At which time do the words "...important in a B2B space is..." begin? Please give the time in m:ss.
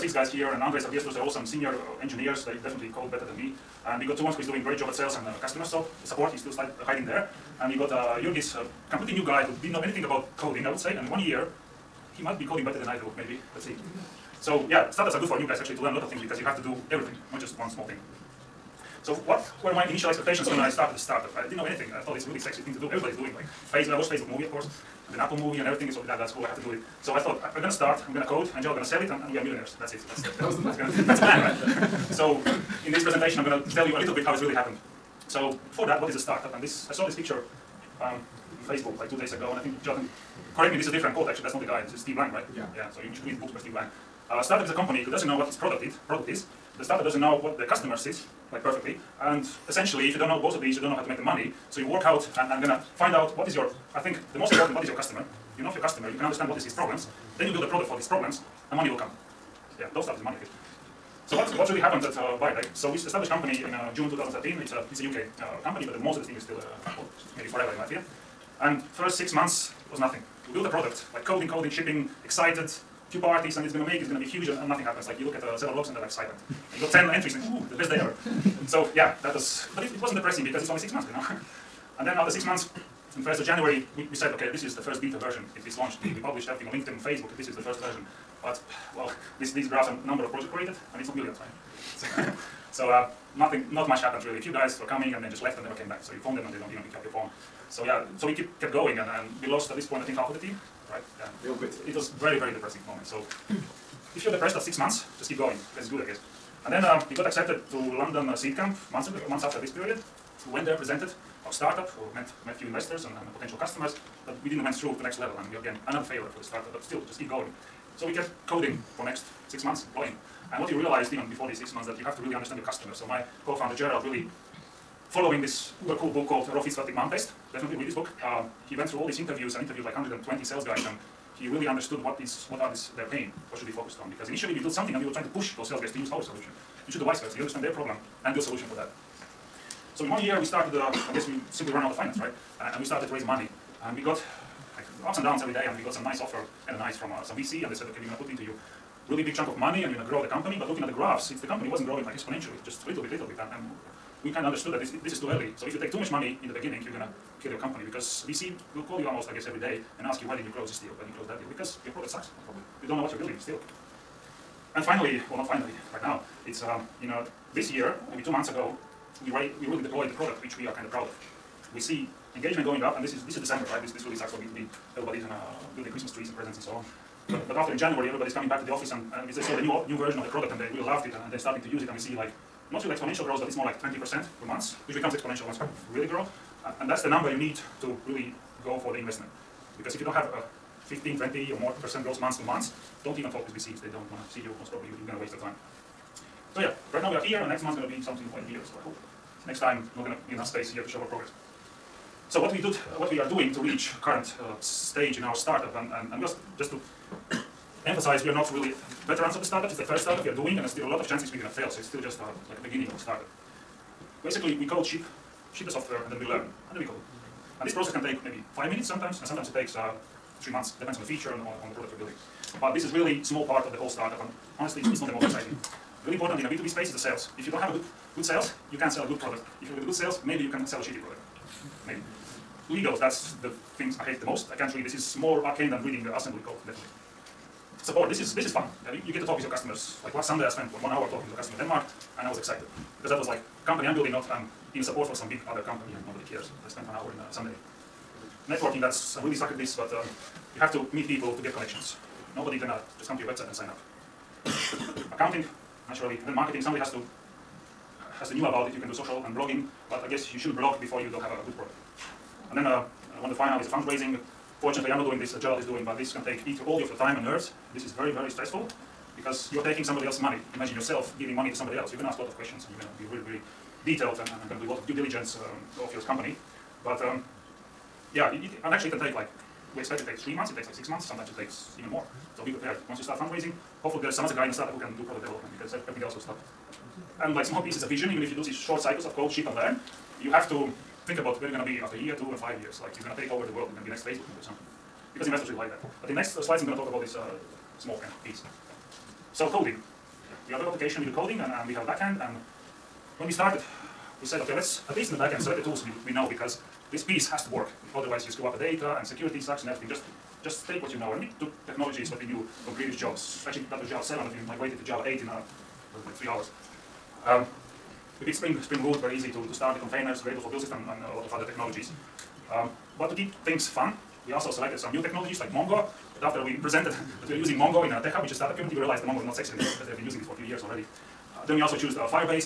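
3:46.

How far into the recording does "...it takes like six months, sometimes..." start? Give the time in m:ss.
4:40.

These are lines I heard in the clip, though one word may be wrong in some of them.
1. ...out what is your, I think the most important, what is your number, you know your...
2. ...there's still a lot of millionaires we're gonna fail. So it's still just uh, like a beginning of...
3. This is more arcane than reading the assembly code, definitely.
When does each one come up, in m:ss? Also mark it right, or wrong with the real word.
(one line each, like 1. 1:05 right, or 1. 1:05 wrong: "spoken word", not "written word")
1. 0:53 wrong: "customer", not "number"
2. 3:30 wrong: "chances", not "millionaires"
3. 3:54 right.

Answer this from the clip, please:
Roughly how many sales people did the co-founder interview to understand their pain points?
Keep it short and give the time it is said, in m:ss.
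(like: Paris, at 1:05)
120, at 2:09.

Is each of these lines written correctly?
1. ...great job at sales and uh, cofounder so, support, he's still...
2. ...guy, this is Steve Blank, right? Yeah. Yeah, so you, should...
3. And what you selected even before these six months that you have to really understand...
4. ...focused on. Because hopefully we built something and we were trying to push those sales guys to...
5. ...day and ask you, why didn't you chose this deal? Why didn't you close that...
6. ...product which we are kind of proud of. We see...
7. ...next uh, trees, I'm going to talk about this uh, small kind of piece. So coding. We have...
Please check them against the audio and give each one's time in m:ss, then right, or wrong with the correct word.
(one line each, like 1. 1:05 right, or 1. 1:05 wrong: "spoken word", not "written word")
1. 0:04 wrong: "customer", not "cofounder"
2. 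0:41 right
3. 2:00 wrong: "realized", not "selected"
4. 2:13 wrong: "initially", not "hopefully"
5. 2:39 wrong: "close", not "chose"
6. 2:50 right
7. 4:56 wrong: "slides", not "trees".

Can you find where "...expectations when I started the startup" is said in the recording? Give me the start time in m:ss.
0:20.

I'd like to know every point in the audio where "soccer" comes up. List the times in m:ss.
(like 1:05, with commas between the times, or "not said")
not said.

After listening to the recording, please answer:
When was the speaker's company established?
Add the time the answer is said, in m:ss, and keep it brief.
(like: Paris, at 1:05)
June 2013, at 1:03.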